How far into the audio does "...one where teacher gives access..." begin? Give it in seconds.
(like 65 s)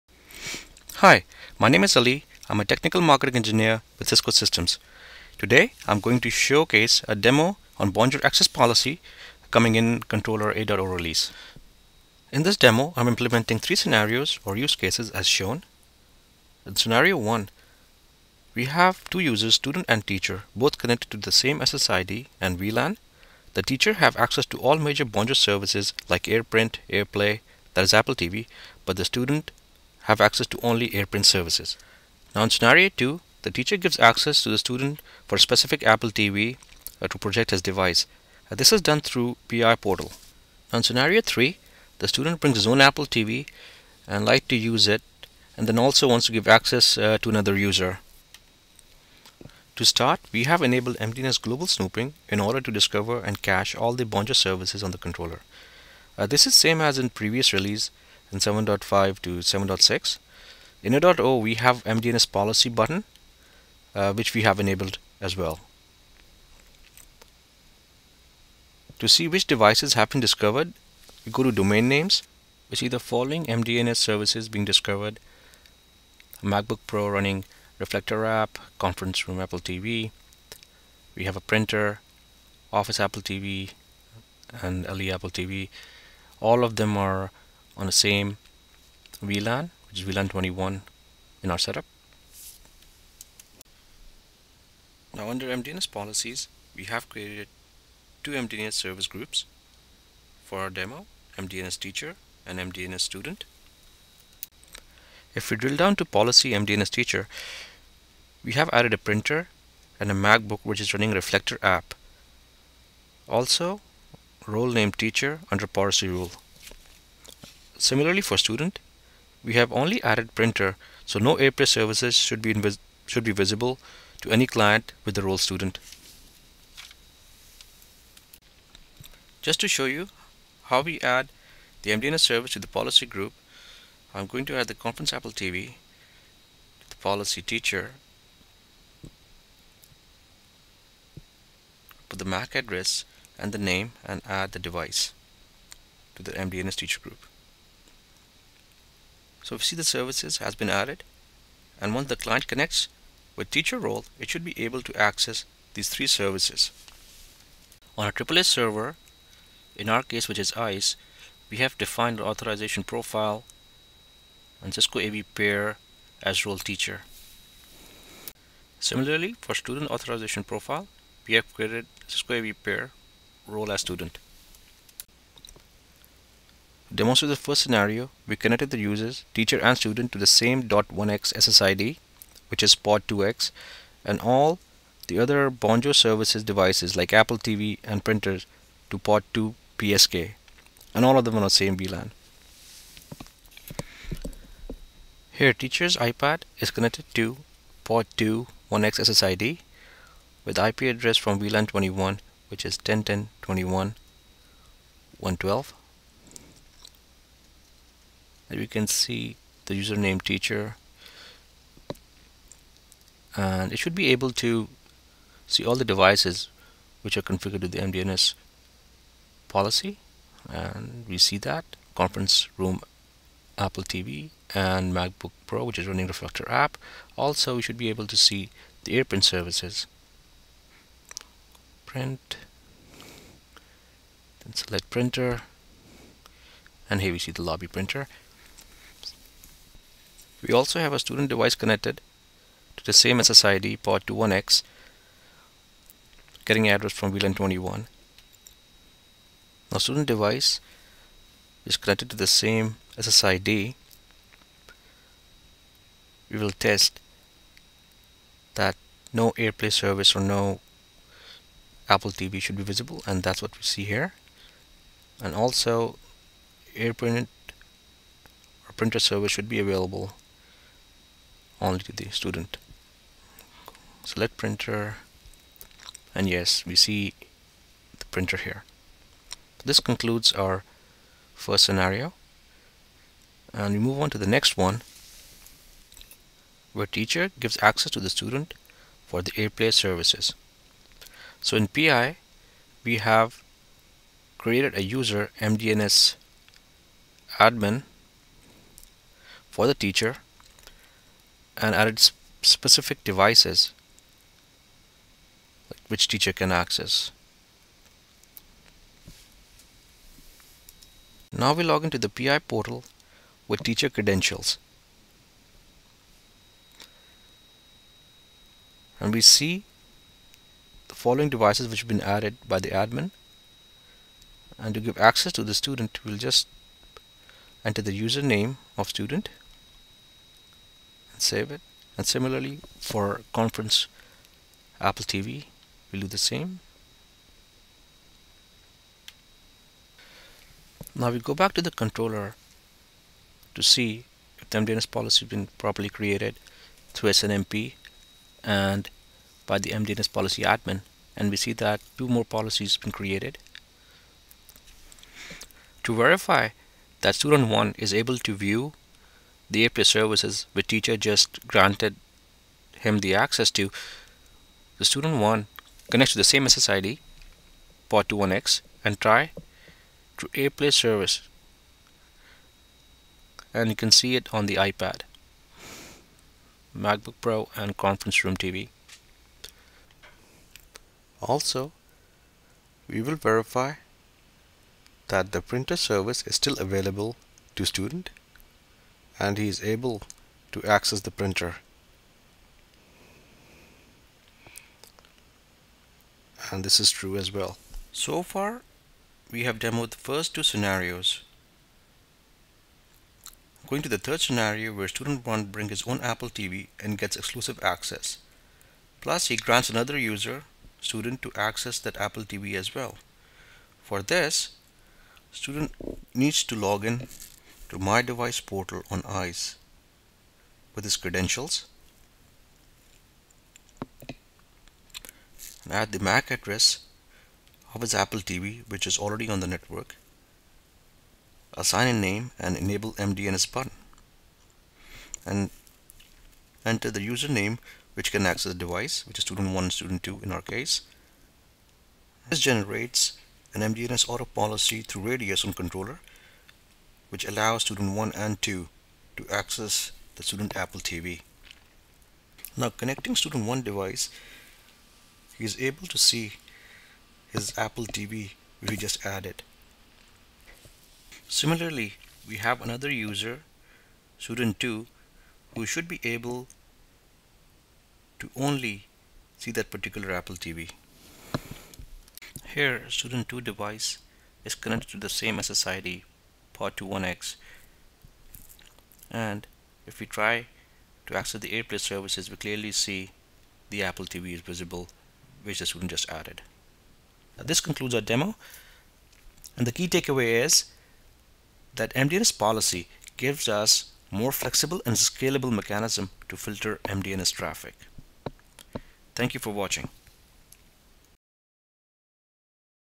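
284 s.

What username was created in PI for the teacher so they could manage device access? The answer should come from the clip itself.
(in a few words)
MDNS admin.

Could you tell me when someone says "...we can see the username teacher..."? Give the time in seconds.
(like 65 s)
208 s.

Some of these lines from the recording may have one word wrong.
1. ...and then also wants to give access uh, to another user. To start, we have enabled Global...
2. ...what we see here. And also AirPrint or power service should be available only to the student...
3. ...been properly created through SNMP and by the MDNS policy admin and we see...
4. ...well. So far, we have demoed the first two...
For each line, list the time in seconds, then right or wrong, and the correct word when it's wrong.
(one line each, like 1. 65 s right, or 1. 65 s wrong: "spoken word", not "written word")
1. 45 s wrong: "MDNS", not "Global"
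2. 263 s wrong: "printer", not "power"
3. 345 s right
4. 397 s right.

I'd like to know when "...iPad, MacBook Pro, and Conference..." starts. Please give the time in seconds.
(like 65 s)
374 s.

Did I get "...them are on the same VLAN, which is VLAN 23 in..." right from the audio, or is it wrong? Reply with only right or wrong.
wrong.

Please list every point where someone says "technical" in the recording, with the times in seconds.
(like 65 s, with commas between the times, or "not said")
2 s.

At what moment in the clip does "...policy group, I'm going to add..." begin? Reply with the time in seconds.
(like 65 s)
132 s.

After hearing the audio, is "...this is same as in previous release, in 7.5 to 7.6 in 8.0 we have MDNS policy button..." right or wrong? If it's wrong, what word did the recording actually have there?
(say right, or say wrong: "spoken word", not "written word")
right.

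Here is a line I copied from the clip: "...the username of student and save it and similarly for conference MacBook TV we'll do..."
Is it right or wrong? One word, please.
wrong.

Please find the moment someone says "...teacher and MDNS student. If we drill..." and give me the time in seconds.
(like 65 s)
101 s.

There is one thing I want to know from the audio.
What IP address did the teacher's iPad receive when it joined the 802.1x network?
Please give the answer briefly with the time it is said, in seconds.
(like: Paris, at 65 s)
10.10.21.112, at 202 s.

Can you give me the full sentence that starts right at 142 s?
Put the MAC address and the name and add the device to the MDNS teacher group.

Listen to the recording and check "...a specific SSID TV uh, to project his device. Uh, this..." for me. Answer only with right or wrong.
wrong.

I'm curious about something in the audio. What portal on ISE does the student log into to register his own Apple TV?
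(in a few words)
My Device portal.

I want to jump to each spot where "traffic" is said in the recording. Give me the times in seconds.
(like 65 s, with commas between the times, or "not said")
497 s.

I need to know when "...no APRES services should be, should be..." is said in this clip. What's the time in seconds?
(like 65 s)
121 s.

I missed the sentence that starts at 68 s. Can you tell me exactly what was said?
To see which devices have been discovered, we go to domain names.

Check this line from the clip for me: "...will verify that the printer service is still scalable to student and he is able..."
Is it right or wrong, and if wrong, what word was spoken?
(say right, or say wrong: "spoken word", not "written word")
wrong: "available", not "scalable".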